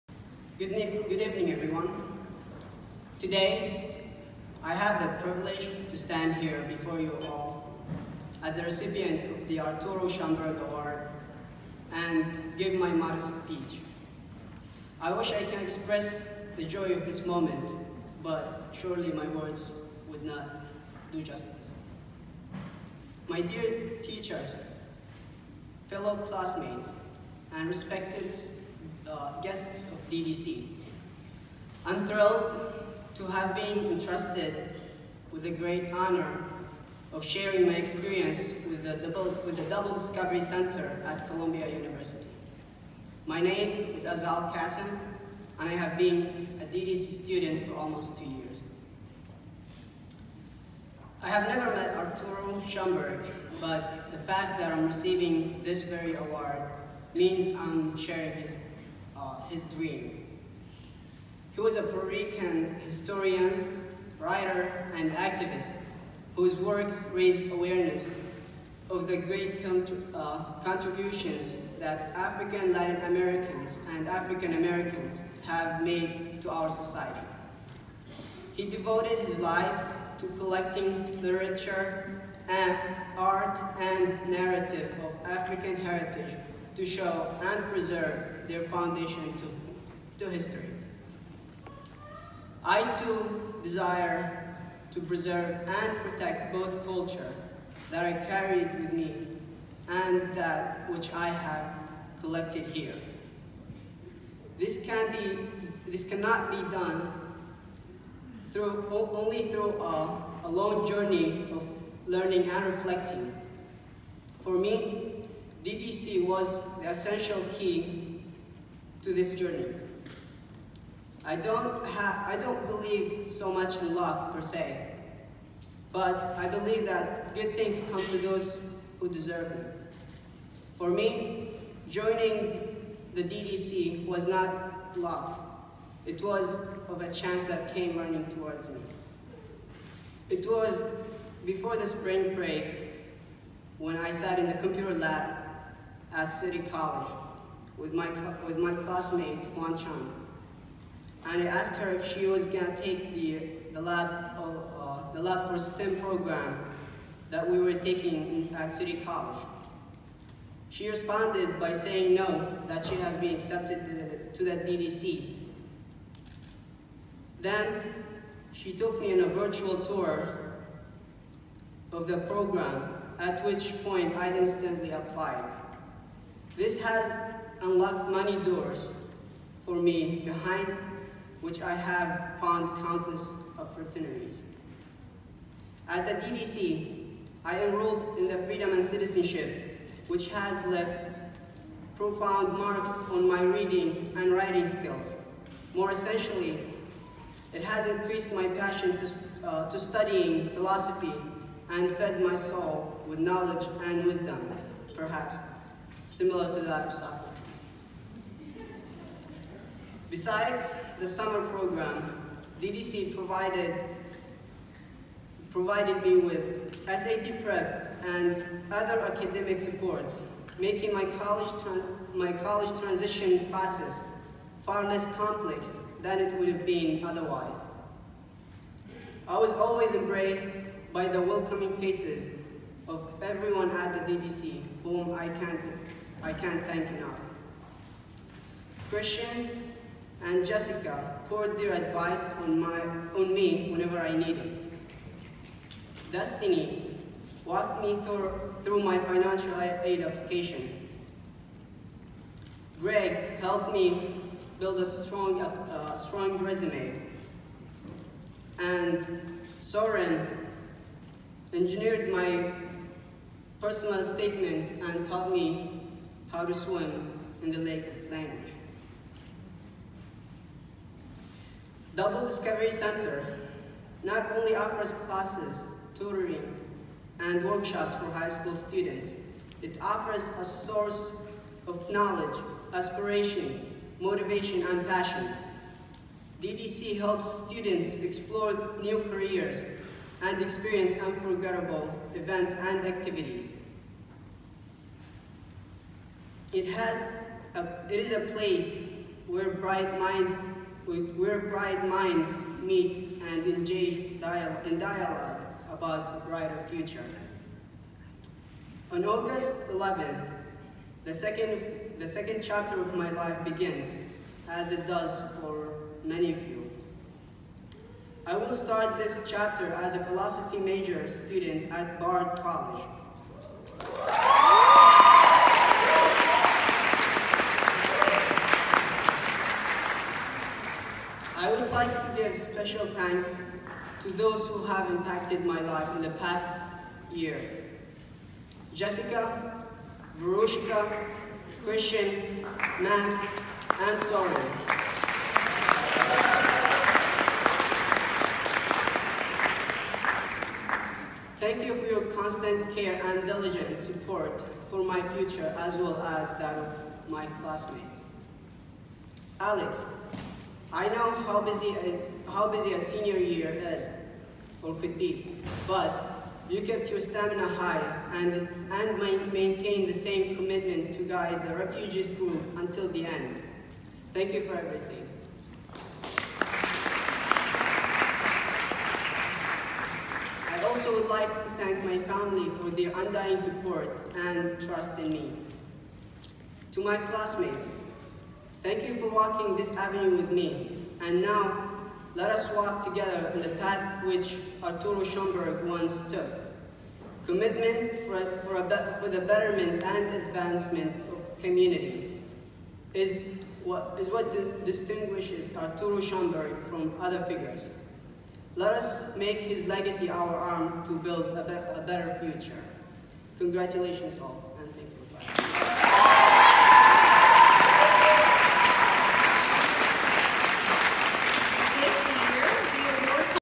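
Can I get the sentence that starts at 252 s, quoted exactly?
Greg helped me build a strong, a uh, strong resume.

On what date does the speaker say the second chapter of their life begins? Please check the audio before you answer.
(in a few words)
August 11th.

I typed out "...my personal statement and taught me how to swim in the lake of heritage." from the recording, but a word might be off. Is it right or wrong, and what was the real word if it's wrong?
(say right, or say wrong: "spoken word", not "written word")
wrong: "language", not "heritage".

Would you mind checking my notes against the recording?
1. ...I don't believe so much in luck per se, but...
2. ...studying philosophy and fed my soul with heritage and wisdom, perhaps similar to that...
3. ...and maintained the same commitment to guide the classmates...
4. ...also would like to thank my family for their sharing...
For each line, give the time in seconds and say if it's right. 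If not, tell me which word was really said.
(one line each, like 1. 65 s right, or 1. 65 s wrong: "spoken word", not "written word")
1. 122 s right
2. 199 s wrong: "knowledge", not "heritage"
3. 368 s wrong: "refugees", not "classmates"
4. 380 s wrong: "undying", not "sharing".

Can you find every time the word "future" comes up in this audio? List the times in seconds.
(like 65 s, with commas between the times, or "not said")
306 s, 355 s, 412 s.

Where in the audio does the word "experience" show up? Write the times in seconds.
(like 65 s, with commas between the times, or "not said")
37 s, 290 s.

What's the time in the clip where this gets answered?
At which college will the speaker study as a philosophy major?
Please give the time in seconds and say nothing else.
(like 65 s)
321 s.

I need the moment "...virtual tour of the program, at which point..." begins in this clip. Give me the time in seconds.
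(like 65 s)
169 s.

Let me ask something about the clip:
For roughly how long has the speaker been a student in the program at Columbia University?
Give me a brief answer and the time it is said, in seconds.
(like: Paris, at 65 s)
almost two years, at 47 s.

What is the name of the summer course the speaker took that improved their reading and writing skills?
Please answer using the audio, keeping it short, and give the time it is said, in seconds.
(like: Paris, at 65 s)
Freedom and Citizenship, at 188 s.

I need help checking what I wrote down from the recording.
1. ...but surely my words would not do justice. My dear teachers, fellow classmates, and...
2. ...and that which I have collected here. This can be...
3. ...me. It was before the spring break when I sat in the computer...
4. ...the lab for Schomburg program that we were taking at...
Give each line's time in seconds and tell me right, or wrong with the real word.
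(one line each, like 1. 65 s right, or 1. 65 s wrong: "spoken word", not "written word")
1. 18 s right
2. 99 s right
3. 138 s right
4. 155 s wrong: "STEM", not "Schomburg".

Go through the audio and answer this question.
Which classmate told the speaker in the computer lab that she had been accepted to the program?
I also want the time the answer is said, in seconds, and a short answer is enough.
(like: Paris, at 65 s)
Huan Chan, at 149 s.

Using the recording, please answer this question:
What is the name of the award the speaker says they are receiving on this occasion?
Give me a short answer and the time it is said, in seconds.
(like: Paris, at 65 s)
Arturo Schomburg Award, at 9 s.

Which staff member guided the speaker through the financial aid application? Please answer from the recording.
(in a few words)
Destiny.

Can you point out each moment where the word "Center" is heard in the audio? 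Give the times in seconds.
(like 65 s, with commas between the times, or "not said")
40 s, 272 s.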